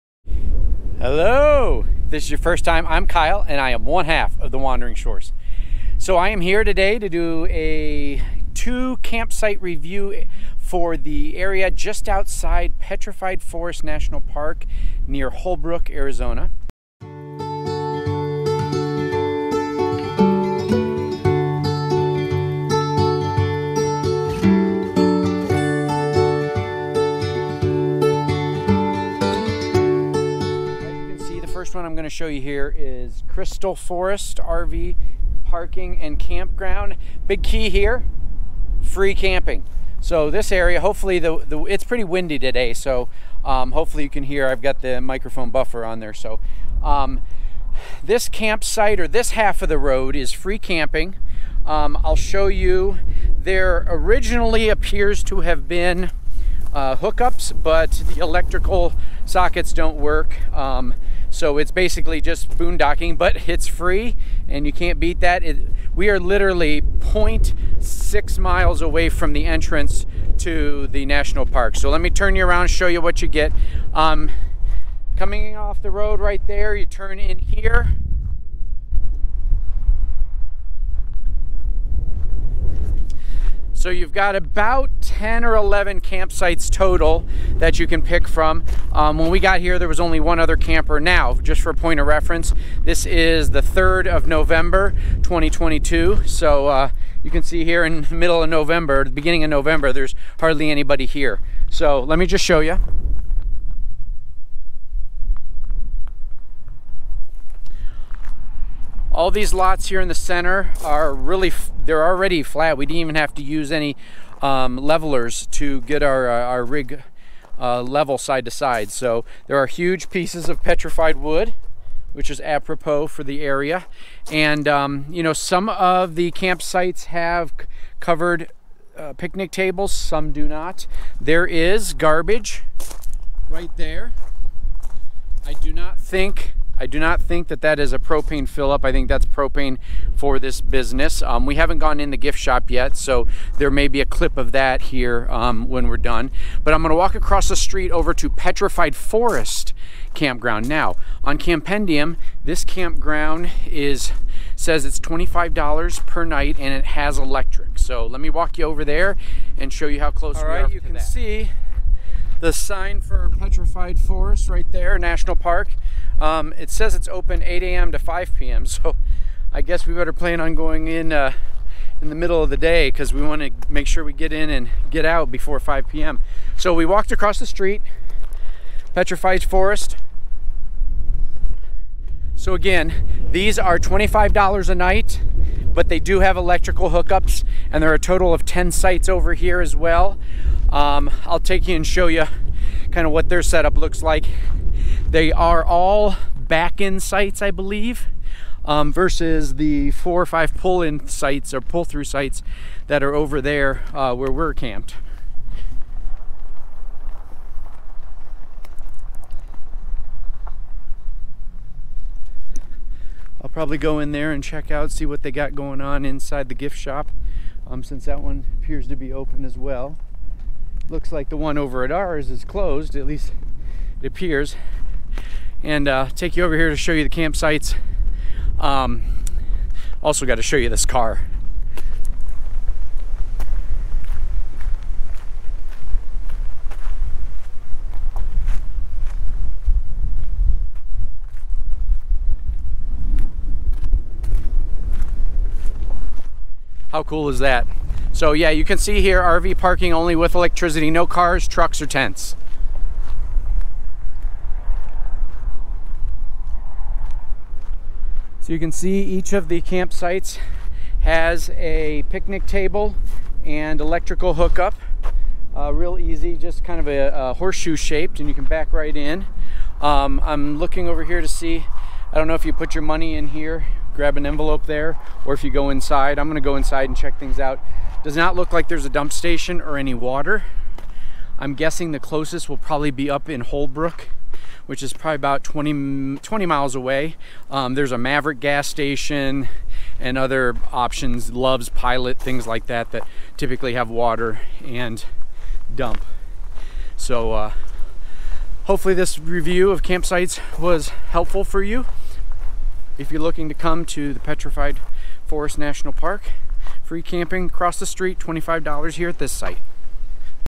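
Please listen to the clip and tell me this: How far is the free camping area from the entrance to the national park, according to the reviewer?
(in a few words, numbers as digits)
0.6 miles.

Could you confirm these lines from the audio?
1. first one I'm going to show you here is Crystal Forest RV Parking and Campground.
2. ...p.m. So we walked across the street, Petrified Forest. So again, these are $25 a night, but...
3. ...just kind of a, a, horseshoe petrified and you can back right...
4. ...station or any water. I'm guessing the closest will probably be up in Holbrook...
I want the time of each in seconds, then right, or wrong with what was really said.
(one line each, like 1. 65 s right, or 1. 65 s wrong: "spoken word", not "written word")
1. 31 s right
2. 175 s right
3. 266 s wrong: "shaped", not "petrified"
4. 279 s right.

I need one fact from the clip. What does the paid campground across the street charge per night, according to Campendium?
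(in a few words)
$25.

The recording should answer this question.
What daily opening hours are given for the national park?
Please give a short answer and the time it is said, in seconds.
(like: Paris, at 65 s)
8 a.m. to 5 p.m., at 167 s.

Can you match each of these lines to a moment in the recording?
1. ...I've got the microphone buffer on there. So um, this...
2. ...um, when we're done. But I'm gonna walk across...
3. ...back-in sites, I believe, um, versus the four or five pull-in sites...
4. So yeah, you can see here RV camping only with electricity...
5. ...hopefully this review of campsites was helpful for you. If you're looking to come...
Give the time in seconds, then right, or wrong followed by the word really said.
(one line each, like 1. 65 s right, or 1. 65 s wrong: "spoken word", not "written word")
1. 44 s right
2. 145 s right
3. 196 s right
4. 248 s wrong: "parking", not "camping"
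5. 298 s right.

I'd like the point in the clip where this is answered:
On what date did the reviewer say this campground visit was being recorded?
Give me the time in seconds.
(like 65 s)
93 s.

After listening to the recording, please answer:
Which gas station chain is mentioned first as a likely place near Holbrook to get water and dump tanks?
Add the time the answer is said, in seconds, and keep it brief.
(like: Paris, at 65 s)
Maverick, at 287 s.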